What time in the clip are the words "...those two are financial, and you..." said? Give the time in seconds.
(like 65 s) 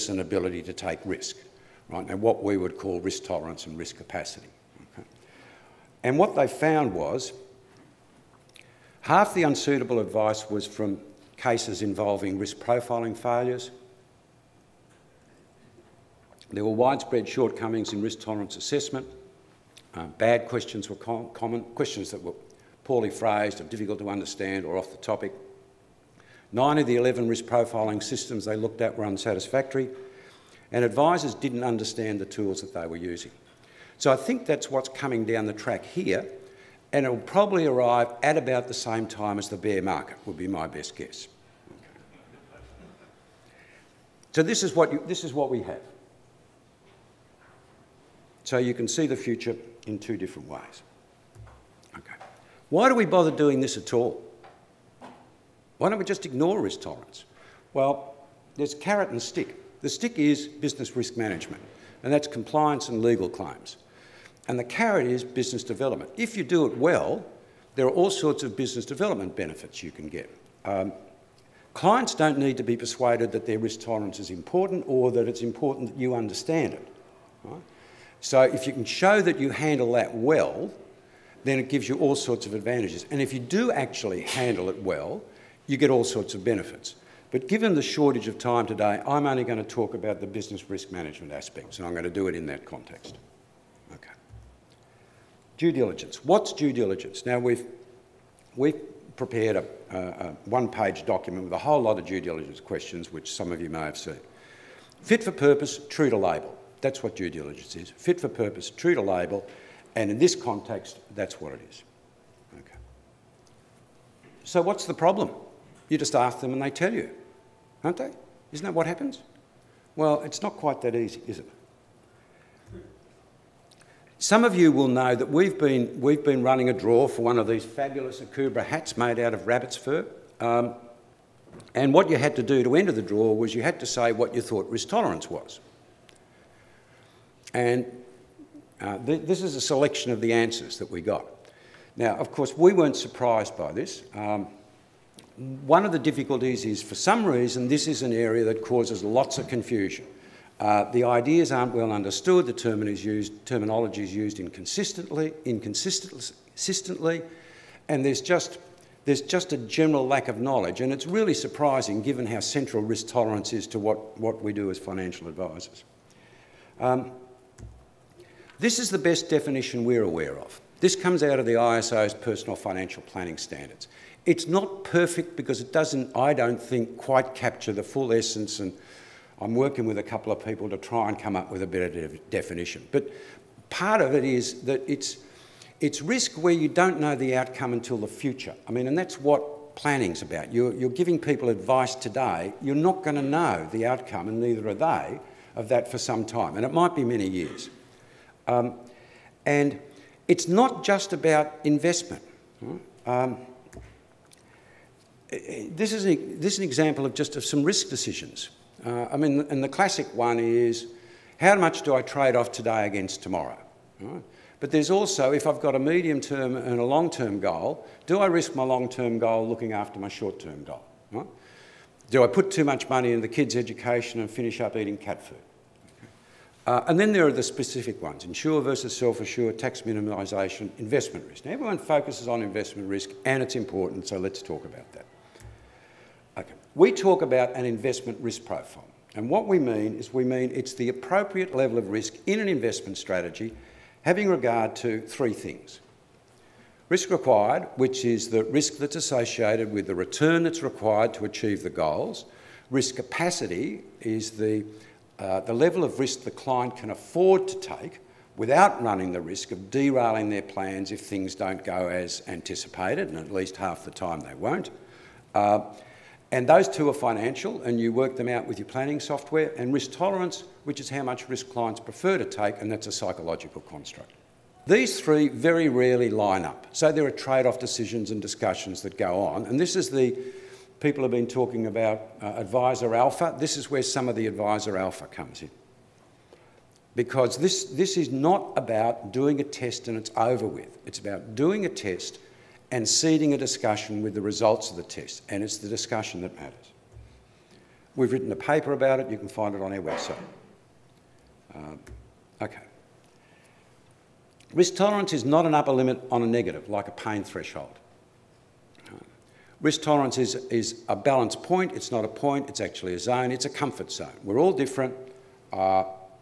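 266 s.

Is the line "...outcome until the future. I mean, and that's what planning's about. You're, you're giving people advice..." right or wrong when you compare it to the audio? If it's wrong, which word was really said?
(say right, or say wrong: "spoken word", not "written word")
right.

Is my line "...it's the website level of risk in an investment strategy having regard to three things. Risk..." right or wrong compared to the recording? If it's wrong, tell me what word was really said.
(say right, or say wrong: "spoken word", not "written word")
wrong: "appropriate", not "website".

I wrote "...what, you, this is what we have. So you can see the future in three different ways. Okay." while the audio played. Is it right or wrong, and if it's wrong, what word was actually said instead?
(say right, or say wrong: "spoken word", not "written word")
wrong: "two", not "three".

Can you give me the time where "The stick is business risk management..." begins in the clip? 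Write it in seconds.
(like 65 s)
59 s.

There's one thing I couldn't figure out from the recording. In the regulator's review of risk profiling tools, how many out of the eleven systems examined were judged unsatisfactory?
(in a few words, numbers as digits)
9.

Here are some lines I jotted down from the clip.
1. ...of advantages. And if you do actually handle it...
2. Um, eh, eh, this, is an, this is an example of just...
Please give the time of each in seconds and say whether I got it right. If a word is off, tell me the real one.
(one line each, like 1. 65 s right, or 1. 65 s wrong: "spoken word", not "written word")
1. 82 s right
2. 203 s right.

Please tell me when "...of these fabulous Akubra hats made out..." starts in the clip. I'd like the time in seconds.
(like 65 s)
127 s.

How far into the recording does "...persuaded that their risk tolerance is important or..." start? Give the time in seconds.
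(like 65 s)
72 s.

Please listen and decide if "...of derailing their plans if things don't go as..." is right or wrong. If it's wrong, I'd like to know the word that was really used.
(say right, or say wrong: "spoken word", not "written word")
right.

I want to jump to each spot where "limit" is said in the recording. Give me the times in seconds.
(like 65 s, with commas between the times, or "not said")
305 s.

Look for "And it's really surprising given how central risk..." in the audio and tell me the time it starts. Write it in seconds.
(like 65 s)
160 s.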